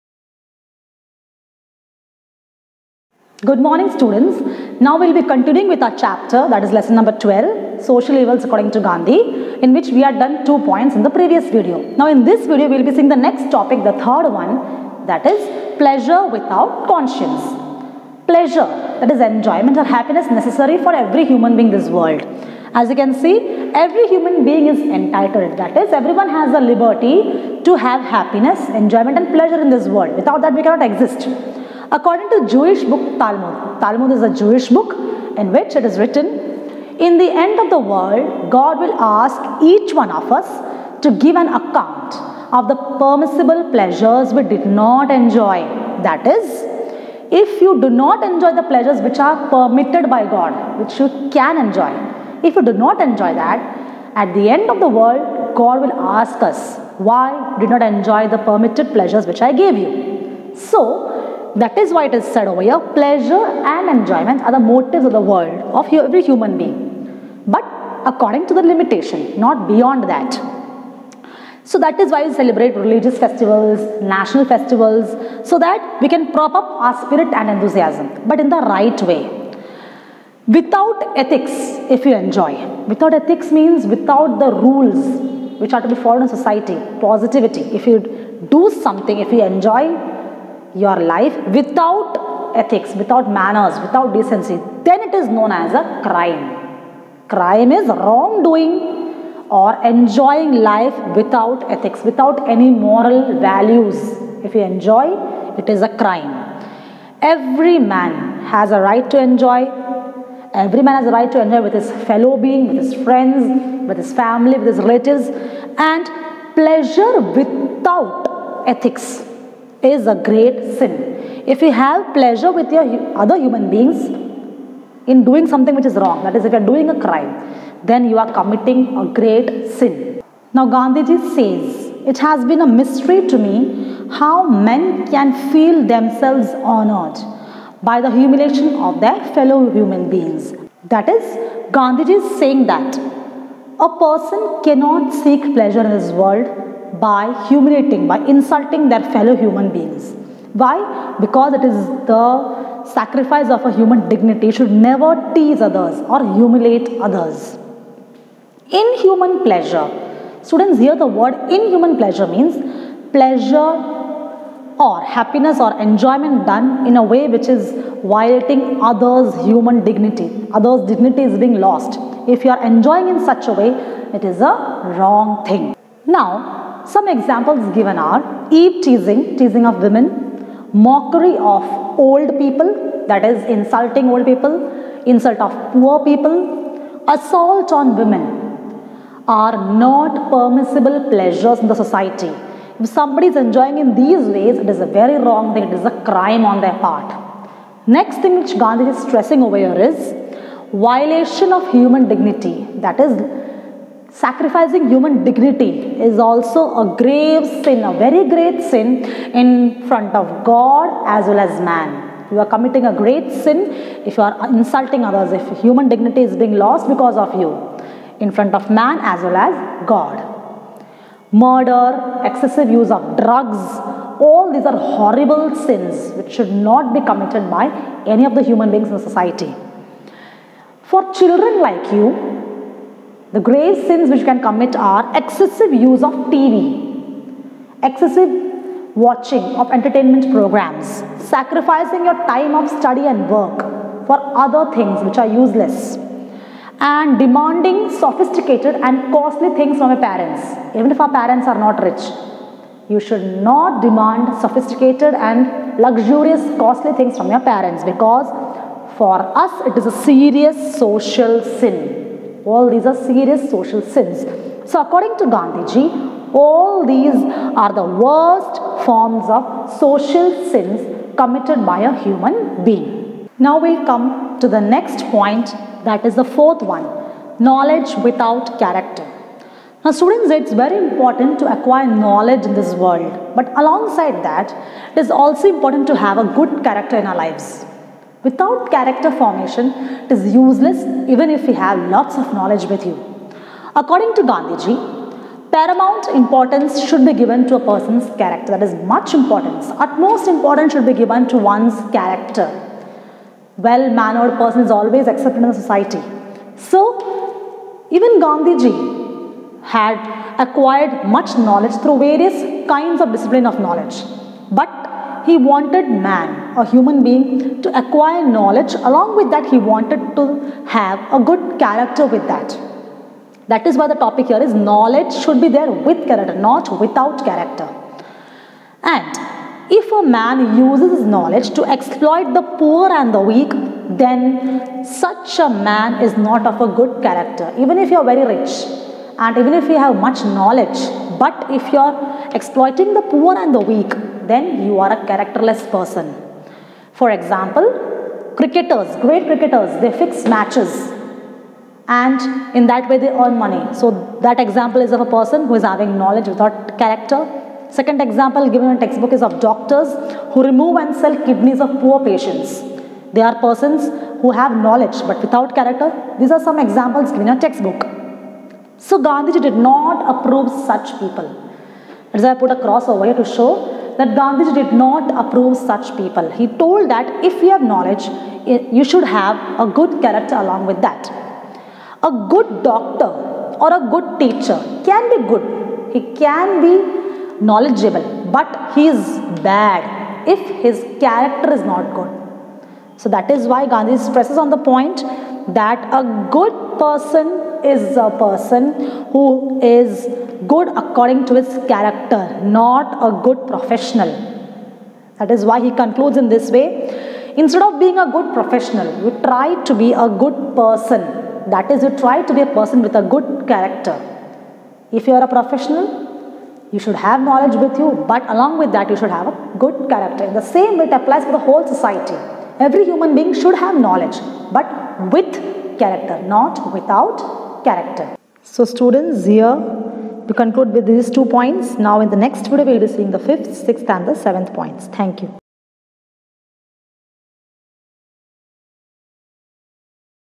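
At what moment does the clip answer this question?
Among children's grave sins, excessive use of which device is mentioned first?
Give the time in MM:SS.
03:56.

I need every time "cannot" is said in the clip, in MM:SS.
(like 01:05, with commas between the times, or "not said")
00:30, 02:24.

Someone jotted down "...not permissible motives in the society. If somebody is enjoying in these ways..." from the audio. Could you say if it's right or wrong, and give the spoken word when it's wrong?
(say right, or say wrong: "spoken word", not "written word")
wrong: "pleasures", not "motives".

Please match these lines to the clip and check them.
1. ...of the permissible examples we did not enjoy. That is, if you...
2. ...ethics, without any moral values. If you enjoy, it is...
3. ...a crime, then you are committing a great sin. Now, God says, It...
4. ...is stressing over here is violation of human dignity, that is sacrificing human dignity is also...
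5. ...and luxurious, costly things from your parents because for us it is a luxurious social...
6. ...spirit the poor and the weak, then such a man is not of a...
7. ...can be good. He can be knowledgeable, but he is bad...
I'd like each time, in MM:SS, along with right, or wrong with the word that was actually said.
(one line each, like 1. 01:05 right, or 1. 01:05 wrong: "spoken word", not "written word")
1. 00:42 wrong: "pleasures", not "examples"
2. 01:41 right
3. 02:06 wrong: "Gandhiji", not "God"
4. 03:18 right
5. 04:15 wrong: "serious", not "luxurious"
6. 05:31 wrong: "exploit", not "spirit"
7. 06:24 right.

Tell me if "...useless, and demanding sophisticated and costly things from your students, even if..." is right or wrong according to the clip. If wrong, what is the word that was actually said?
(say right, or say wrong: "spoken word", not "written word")
wrong: "parents", not "students".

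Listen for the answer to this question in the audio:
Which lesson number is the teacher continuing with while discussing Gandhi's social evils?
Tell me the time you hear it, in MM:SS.
00:06.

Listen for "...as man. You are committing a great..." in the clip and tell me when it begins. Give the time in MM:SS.
03:31.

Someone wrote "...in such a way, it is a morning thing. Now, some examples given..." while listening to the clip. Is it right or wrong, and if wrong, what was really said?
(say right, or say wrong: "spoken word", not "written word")
wrong: "wrong", not "morning".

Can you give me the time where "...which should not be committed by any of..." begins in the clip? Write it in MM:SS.
03:46.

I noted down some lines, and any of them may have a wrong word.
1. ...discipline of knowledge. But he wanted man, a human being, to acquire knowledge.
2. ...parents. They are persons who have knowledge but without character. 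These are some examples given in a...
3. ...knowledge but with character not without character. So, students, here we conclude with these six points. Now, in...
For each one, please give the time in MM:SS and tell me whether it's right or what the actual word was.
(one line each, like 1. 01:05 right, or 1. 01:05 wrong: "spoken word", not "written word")
1. 05:13 right
2. 06:02 wrong: "patients", not "parents"
3. 07:03 wrong: "two", not "six".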